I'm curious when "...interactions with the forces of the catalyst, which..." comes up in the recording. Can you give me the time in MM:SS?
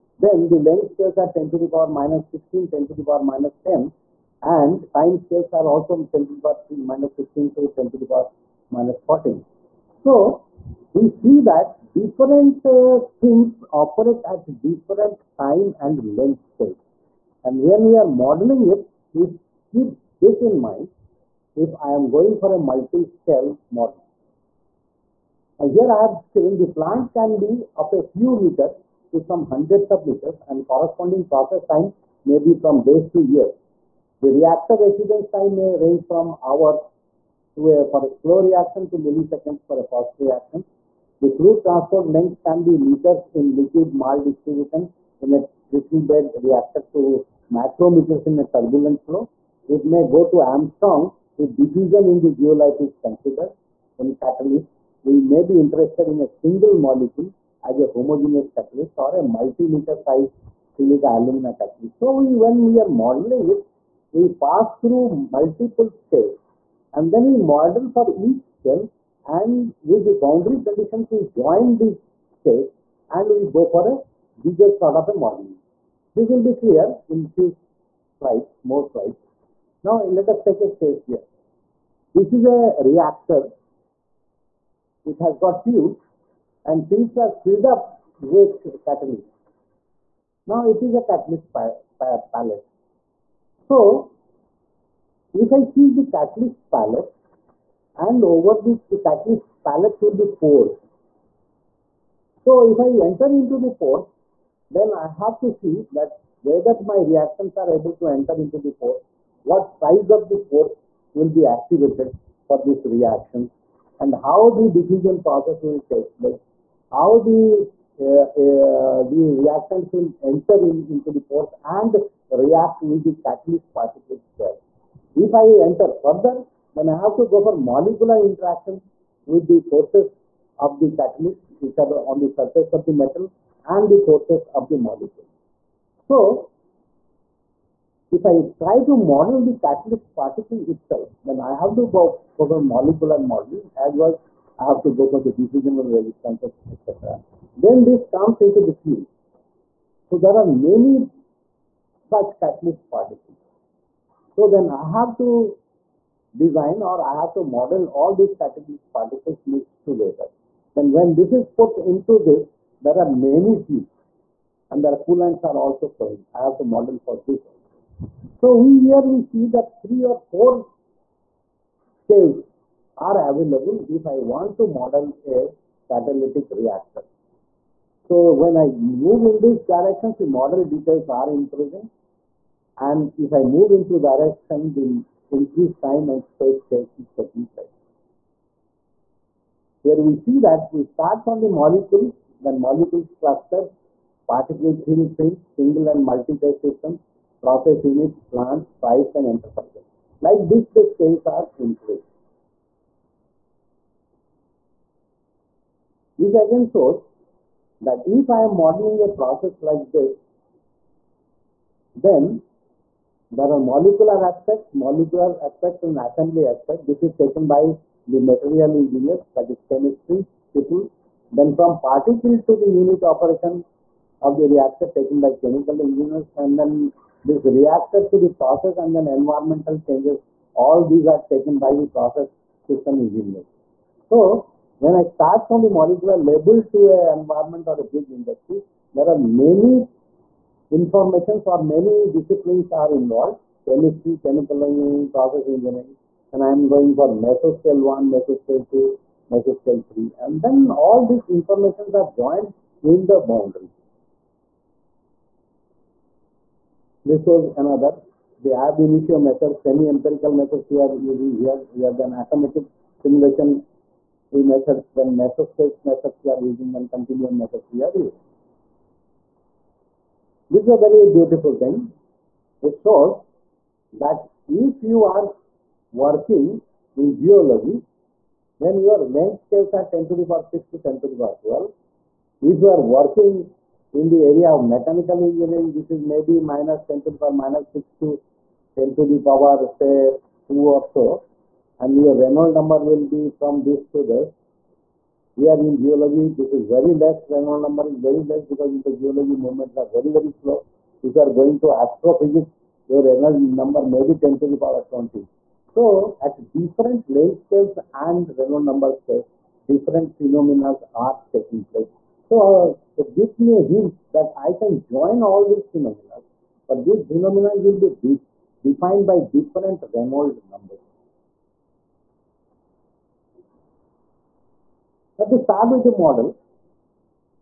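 02:08.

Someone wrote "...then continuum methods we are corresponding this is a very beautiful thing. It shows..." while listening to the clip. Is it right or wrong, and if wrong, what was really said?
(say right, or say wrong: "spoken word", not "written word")
wrong: "using", not "corresponding".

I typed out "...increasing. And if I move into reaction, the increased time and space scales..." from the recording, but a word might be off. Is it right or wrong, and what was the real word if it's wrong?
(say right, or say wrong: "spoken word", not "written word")
wrong: "direction", not "reaction".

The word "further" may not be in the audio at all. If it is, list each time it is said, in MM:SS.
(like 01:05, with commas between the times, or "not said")
02:06.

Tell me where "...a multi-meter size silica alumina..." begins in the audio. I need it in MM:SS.
00:59.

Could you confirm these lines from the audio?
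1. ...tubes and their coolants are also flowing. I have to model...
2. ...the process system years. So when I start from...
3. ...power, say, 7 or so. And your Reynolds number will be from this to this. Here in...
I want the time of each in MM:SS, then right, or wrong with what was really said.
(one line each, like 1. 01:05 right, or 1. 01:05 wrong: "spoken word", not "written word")
1. 02:43 right
2. 03:51 wrong: "engineers", not "years"
3. 04:49 wrong: "2", not "7".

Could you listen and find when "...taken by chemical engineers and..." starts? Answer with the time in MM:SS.
03:44.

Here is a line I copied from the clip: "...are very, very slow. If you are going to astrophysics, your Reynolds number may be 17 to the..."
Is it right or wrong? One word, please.
wrong.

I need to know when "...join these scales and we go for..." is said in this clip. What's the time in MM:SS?
01:11.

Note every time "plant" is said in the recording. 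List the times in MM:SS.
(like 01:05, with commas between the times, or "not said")
00:26, 03:18.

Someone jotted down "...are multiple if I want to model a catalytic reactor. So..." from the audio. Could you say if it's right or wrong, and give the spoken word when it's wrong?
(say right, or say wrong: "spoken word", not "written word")
wrong: "available", not "multiple".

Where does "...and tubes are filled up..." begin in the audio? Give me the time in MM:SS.
01:26.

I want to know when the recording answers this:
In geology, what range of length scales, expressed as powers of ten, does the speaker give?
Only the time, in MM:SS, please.
04:39.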